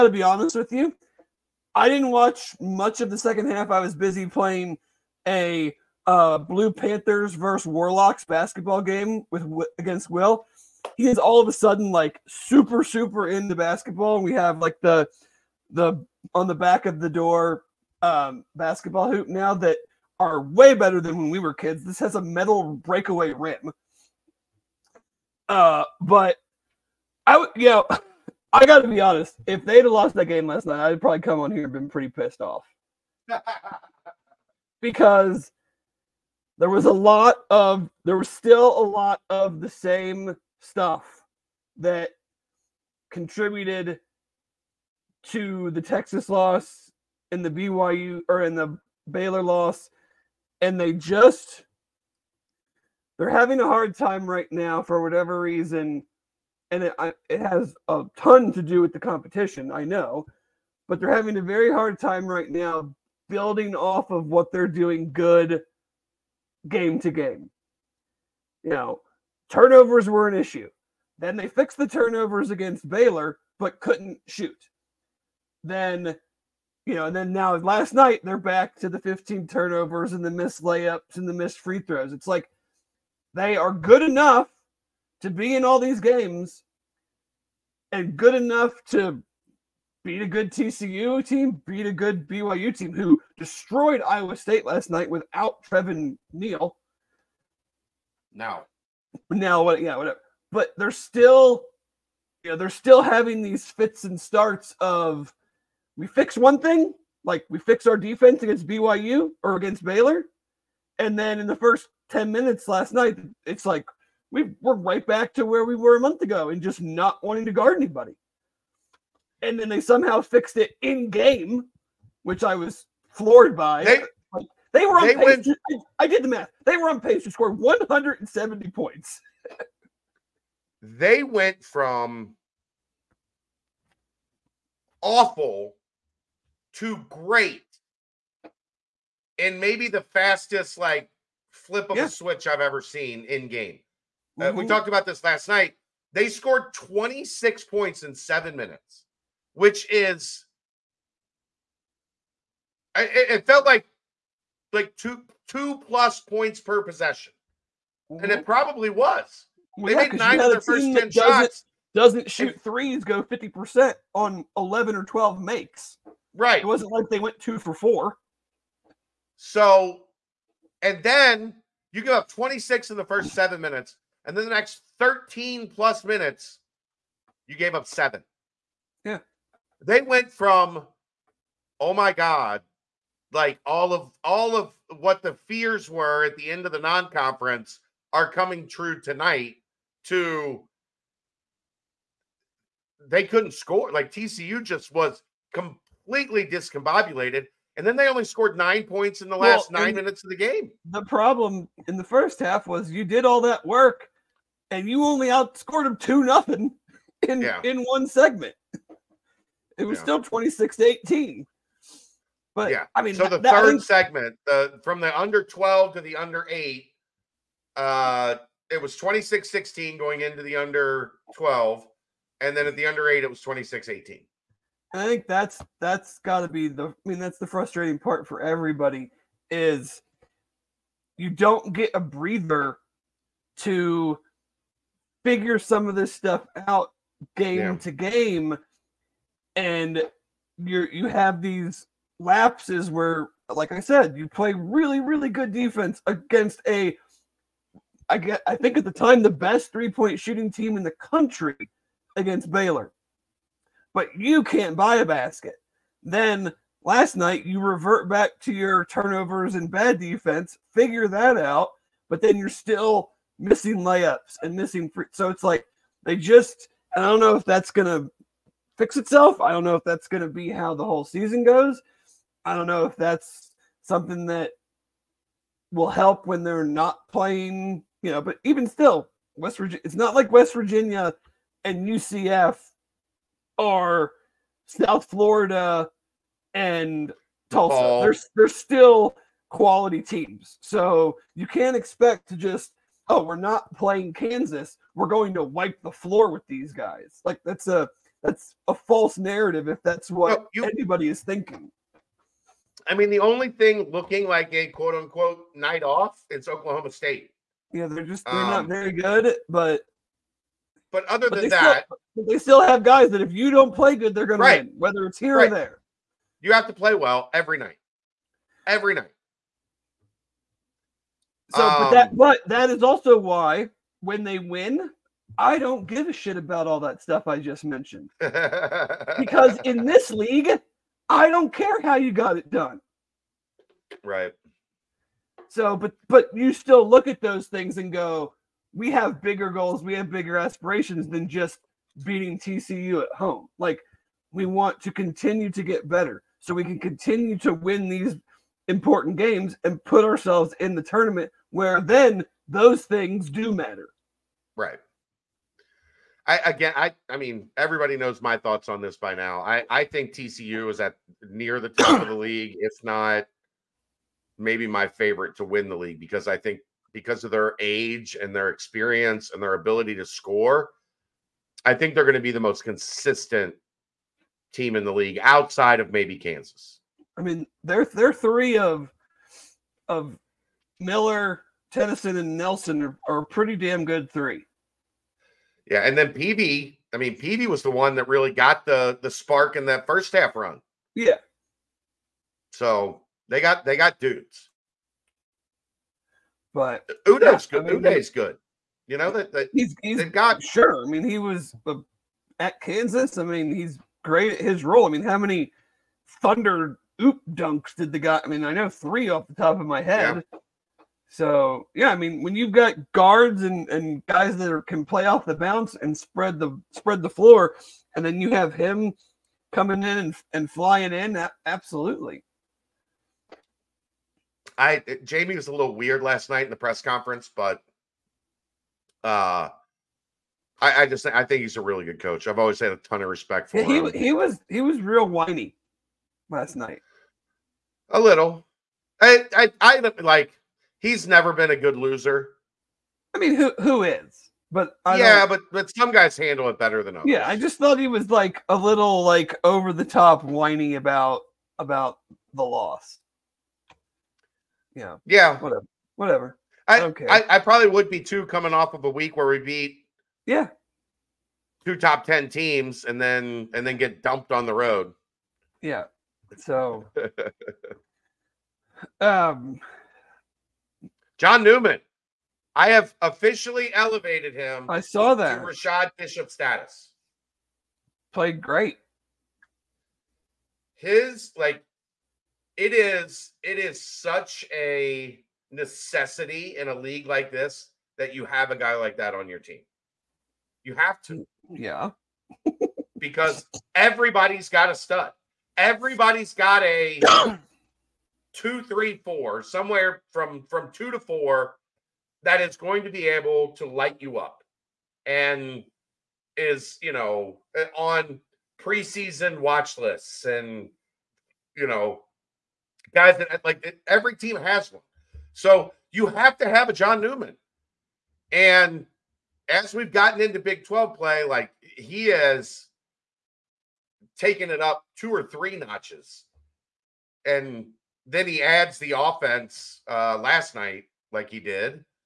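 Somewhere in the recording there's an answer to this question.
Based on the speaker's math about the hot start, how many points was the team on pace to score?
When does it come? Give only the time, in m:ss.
2:07.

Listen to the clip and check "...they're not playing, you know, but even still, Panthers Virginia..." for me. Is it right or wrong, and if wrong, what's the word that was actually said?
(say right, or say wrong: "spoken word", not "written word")
wrong: "West", not "Panthers".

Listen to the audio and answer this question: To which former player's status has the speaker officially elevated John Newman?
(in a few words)
Rashad Bishop.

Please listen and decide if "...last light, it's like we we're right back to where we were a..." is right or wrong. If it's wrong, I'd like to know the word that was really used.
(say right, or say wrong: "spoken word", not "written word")
wrong: "night", not "light".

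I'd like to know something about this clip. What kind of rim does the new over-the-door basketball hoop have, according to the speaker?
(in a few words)
metal breakaway rim.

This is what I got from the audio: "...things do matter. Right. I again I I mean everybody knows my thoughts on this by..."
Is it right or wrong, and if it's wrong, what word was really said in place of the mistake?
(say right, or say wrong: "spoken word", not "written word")
right.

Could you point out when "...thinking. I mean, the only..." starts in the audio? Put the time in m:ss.
5:01.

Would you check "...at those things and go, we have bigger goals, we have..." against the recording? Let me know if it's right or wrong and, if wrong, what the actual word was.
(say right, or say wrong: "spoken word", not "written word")
right.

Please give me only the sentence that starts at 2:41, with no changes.
Doesn't shoot threes go 50% on 11 or 12 makes.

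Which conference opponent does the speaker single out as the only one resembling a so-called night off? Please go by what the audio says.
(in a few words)
Oklahoma State.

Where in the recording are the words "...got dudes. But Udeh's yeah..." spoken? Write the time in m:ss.
6:33.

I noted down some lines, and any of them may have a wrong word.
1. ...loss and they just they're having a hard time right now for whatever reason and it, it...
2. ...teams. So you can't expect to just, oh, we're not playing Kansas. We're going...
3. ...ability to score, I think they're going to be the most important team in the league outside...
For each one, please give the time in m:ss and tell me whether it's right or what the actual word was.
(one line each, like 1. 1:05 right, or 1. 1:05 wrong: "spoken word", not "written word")
1. 0:49 right
2. 4:50 right
3. 6:09 wrong: "consistent", not "important".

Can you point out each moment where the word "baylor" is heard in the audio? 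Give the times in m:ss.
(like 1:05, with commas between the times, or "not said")
0:49, 1:12, 1:49, 4:12.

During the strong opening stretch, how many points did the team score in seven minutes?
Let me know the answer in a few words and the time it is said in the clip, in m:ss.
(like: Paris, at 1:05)
26, at 2:26.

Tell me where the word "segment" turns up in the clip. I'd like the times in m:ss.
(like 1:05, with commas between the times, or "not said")
3:28, 3:33.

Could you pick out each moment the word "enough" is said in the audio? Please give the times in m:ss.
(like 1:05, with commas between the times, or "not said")
1:24, 1:28.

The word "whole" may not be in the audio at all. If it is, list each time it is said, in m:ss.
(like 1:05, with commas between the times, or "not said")
4:30.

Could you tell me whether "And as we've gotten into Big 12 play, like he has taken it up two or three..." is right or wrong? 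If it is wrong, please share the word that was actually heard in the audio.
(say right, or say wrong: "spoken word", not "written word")
right.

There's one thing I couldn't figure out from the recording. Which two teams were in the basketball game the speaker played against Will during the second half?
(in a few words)
Blue Panthers versus Warlocks.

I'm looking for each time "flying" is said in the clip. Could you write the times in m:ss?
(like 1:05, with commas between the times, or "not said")
7:00.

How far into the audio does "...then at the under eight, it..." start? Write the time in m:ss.
3:42.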